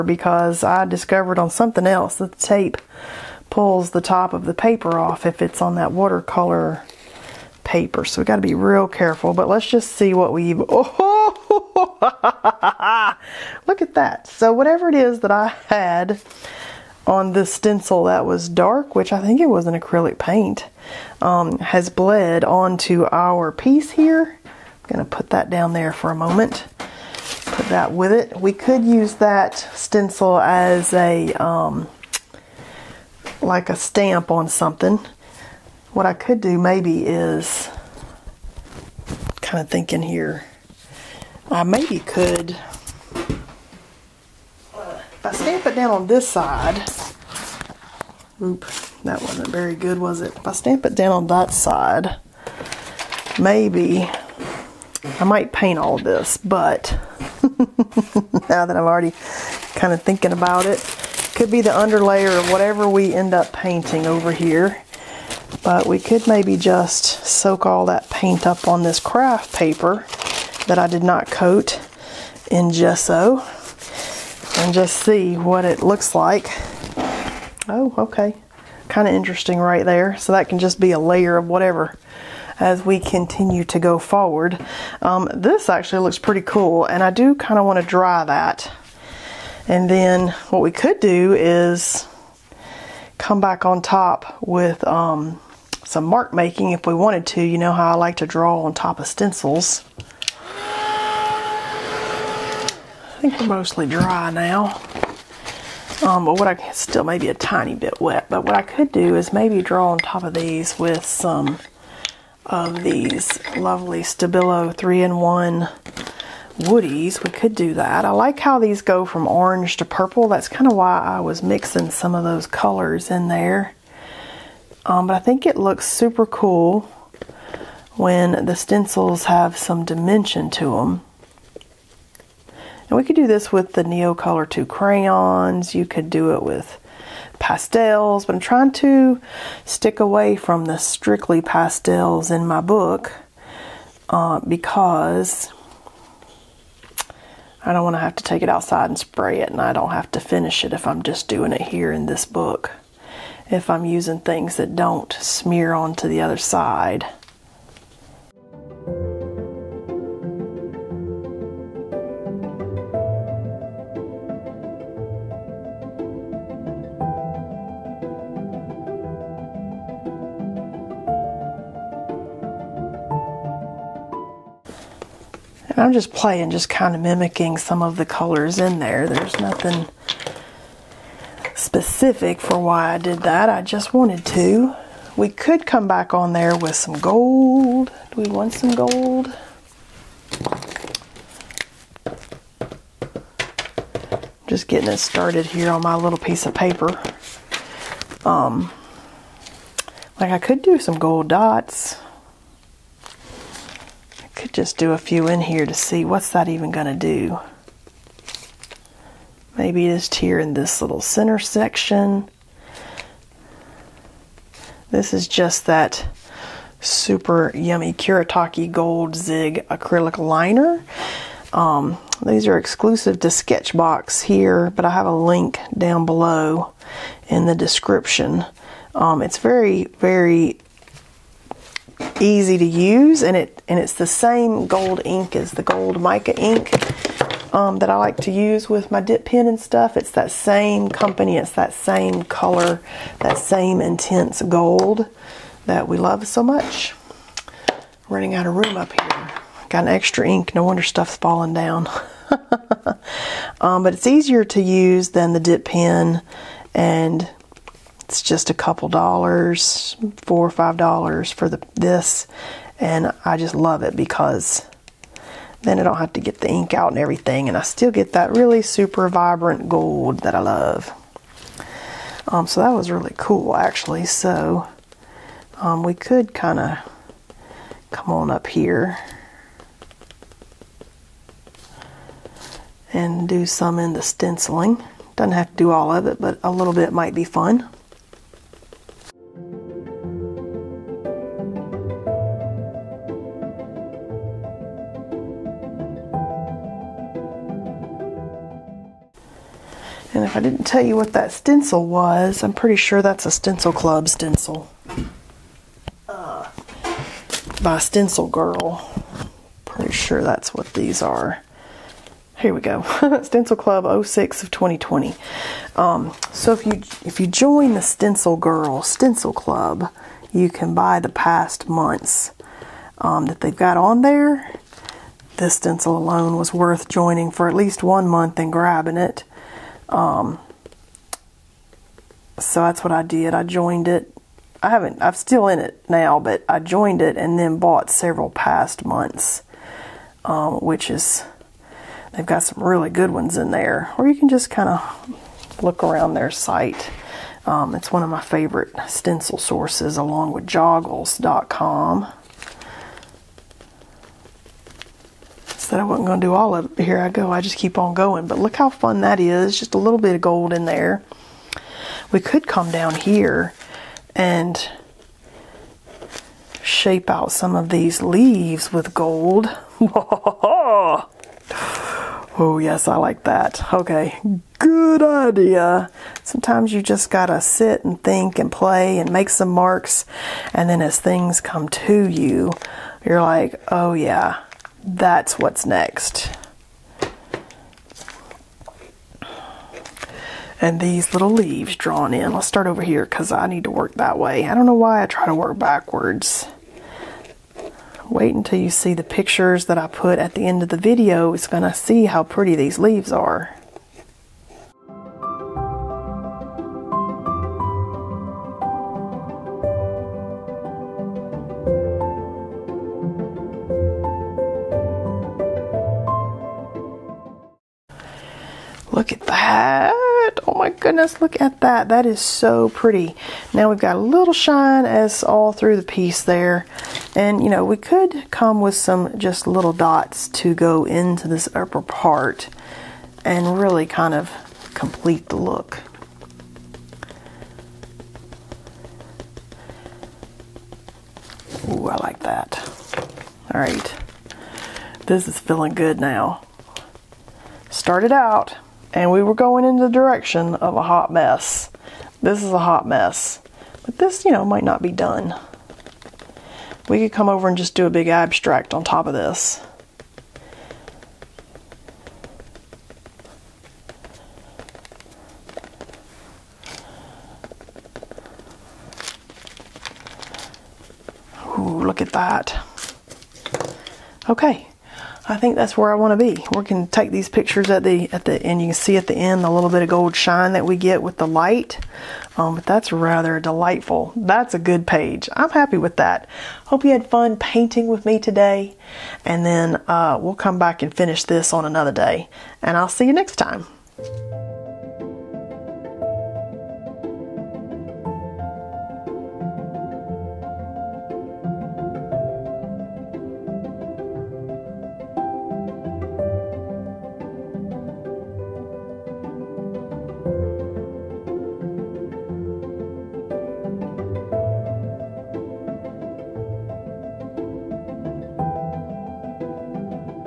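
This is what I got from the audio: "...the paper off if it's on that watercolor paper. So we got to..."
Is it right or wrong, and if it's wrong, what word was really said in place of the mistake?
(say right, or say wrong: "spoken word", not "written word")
right.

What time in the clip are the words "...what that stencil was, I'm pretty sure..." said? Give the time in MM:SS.
05:00.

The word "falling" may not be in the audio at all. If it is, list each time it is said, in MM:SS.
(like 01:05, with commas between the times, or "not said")
04:11.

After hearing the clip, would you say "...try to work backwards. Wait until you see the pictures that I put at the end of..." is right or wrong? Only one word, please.
right.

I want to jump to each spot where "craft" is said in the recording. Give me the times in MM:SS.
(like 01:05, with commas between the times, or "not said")
01:09.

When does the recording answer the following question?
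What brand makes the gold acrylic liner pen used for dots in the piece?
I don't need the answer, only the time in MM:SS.
03:37.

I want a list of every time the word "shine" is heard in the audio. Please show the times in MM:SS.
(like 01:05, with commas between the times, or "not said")
07:04, 08:00.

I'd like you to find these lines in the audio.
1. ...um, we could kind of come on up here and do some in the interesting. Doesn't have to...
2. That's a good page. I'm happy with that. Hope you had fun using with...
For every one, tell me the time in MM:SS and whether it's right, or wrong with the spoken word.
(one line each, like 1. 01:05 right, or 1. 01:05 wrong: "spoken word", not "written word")
1. 04:35 wrong: "stenciling", not "interesting"
2. 08:04 wrong: "painting", not "using".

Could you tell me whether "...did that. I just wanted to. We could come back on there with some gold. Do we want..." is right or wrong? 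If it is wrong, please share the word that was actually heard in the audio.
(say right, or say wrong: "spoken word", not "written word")
right.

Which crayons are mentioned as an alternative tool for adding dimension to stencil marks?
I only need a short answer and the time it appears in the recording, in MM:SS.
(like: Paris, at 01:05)
Neo Color 2, at 02:13.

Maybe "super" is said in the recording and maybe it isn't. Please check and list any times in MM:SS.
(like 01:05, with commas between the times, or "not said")
02:05, 03:36, 04:28.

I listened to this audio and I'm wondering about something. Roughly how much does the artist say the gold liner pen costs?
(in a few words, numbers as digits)
four or five dollars.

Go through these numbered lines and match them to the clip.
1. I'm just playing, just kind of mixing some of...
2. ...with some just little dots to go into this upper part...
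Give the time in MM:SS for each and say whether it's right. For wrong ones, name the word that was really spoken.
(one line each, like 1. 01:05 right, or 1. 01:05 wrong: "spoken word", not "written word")
1. 02:55 wrong: "mimicking", not "mixing"
2. 07:08 right.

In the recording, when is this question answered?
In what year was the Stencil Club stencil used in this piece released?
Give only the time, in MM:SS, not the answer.
05:14.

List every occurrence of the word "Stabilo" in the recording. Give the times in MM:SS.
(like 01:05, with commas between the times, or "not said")
01:54.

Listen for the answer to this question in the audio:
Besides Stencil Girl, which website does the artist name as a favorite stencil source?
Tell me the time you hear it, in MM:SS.
05:50.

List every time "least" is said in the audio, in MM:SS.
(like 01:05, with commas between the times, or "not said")
05:27.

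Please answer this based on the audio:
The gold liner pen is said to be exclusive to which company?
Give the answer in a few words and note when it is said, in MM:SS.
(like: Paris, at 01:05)
Sketchbox, at 03:43.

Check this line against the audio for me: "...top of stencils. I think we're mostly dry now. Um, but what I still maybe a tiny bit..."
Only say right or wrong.
right.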